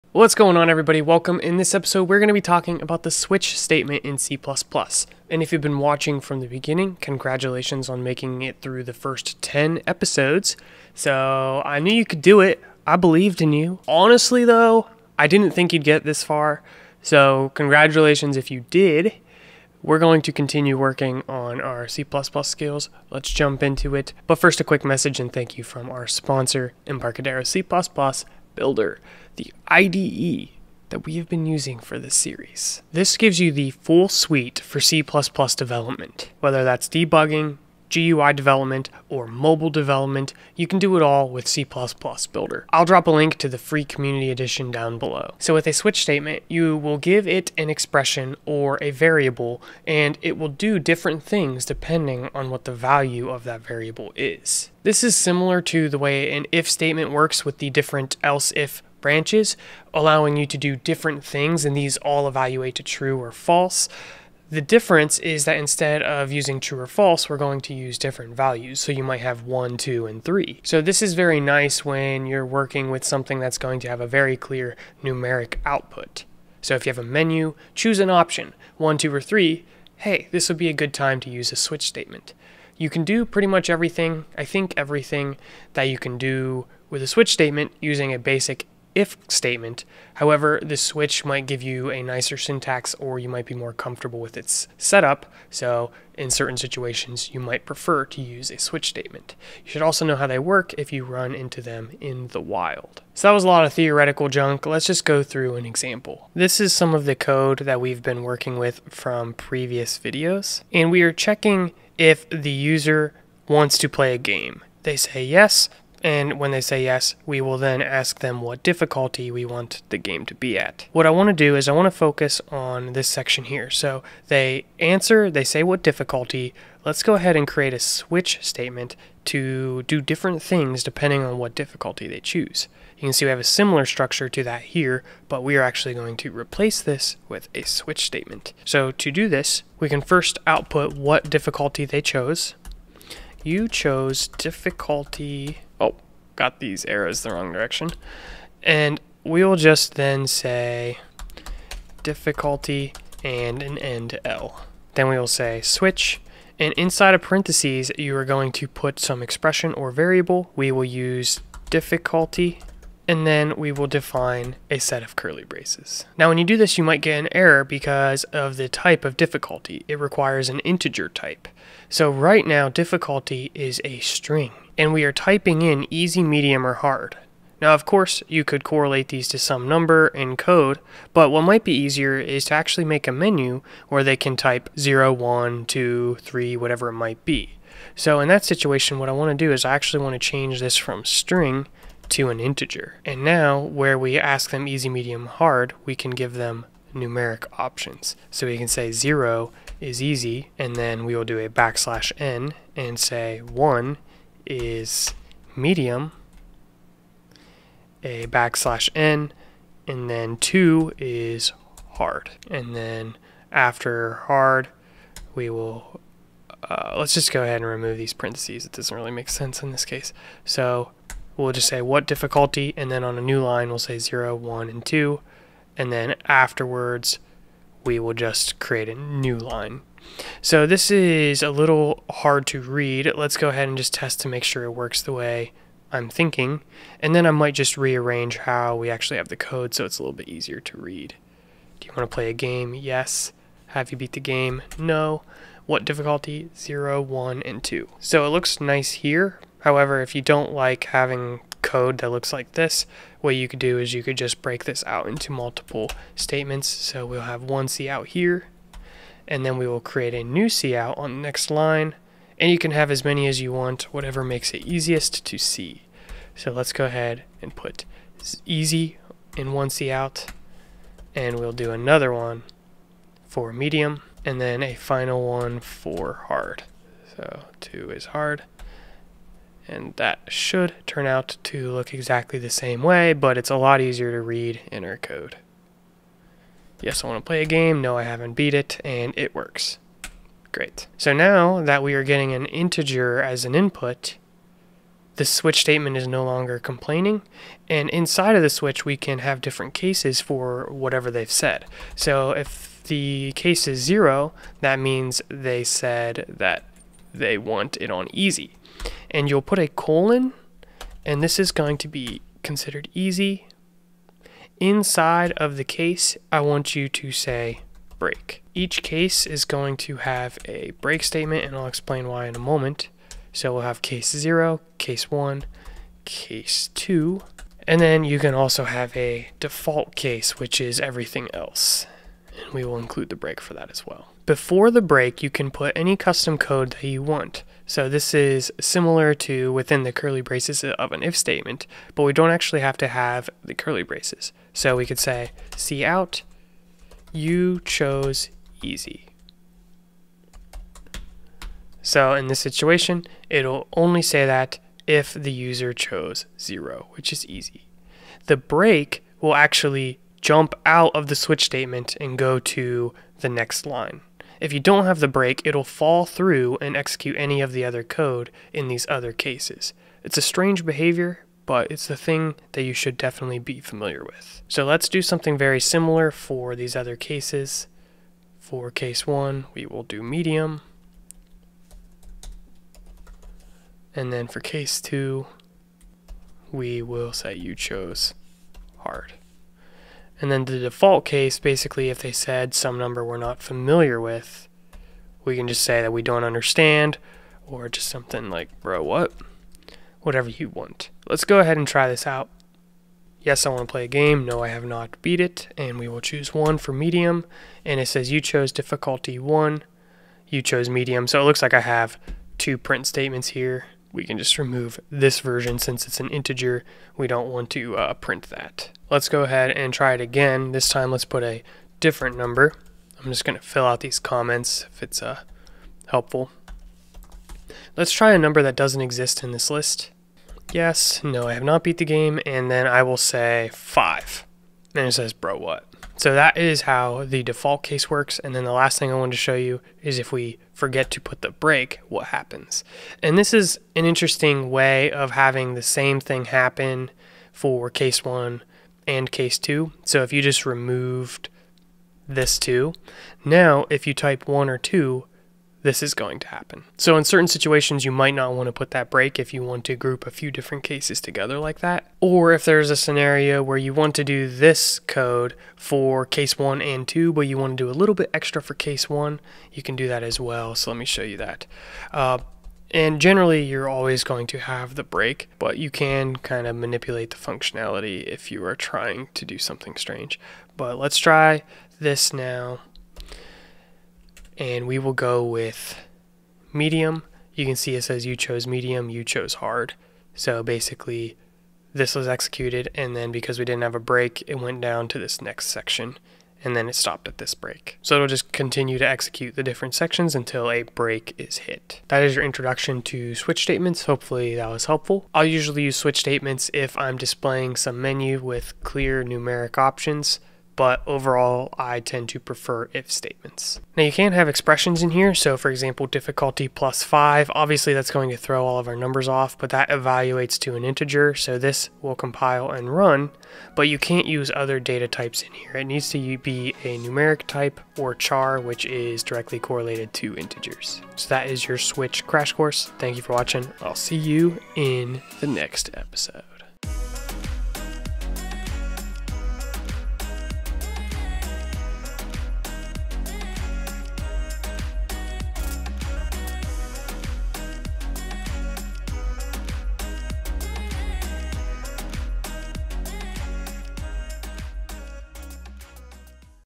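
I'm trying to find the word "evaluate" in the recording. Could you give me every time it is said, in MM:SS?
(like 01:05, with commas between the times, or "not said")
01:02, 08:39.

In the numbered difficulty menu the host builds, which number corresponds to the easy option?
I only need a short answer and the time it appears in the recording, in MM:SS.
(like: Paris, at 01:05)
0, at 03:18.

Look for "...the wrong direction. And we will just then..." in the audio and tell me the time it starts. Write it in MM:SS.
02:27.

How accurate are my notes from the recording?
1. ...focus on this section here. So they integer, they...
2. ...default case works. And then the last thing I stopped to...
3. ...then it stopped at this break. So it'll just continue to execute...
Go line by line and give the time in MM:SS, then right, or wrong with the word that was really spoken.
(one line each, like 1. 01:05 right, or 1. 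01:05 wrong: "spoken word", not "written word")
1. 02:01 wrong: "answer", not "integer"
2. 07:17 wrong: "wanted", not "stopped"
3. 08:16 right.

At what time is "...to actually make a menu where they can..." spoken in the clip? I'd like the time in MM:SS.
03:02.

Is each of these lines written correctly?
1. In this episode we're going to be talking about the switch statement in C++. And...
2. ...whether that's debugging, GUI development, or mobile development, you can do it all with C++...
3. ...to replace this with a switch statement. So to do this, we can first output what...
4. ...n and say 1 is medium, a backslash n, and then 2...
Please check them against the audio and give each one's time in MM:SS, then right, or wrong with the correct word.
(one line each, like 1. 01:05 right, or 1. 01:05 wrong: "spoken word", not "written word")
1. 00:01 right
2. 00:36 right
3. 02:16 right
4. 03:22 right.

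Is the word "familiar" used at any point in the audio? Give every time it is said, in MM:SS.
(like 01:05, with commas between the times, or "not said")
06:13, 06:33.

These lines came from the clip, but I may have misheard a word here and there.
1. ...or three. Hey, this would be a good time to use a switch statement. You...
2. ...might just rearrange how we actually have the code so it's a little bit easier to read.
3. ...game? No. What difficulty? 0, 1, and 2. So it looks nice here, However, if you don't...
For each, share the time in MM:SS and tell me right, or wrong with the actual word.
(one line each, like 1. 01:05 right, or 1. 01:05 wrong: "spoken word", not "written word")
1. 01:19 right
2. 03:57 right
3. 04:04 right.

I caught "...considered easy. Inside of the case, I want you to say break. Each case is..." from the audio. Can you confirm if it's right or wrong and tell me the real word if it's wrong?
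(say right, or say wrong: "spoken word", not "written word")
right.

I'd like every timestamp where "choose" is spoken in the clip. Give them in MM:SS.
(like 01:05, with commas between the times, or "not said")
01:17, 02:12, 06:46.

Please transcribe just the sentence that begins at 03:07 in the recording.
So in that situation what I want to do is I actually want to change this from string to an integer.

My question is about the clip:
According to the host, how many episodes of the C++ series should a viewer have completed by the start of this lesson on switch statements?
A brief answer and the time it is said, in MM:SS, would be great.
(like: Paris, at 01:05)
10, at 00:09.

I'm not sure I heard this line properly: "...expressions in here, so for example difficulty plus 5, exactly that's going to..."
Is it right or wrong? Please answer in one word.
wrong.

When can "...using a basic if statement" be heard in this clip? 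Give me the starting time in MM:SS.
01:27.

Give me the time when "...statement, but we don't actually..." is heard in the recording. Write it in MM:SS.
05:41.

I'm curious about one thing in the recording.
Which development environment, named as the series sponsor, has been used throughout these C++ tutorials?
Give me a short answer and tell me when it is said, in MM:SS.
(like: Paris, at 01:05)
Embarcadero C++ Builder, at 00:26.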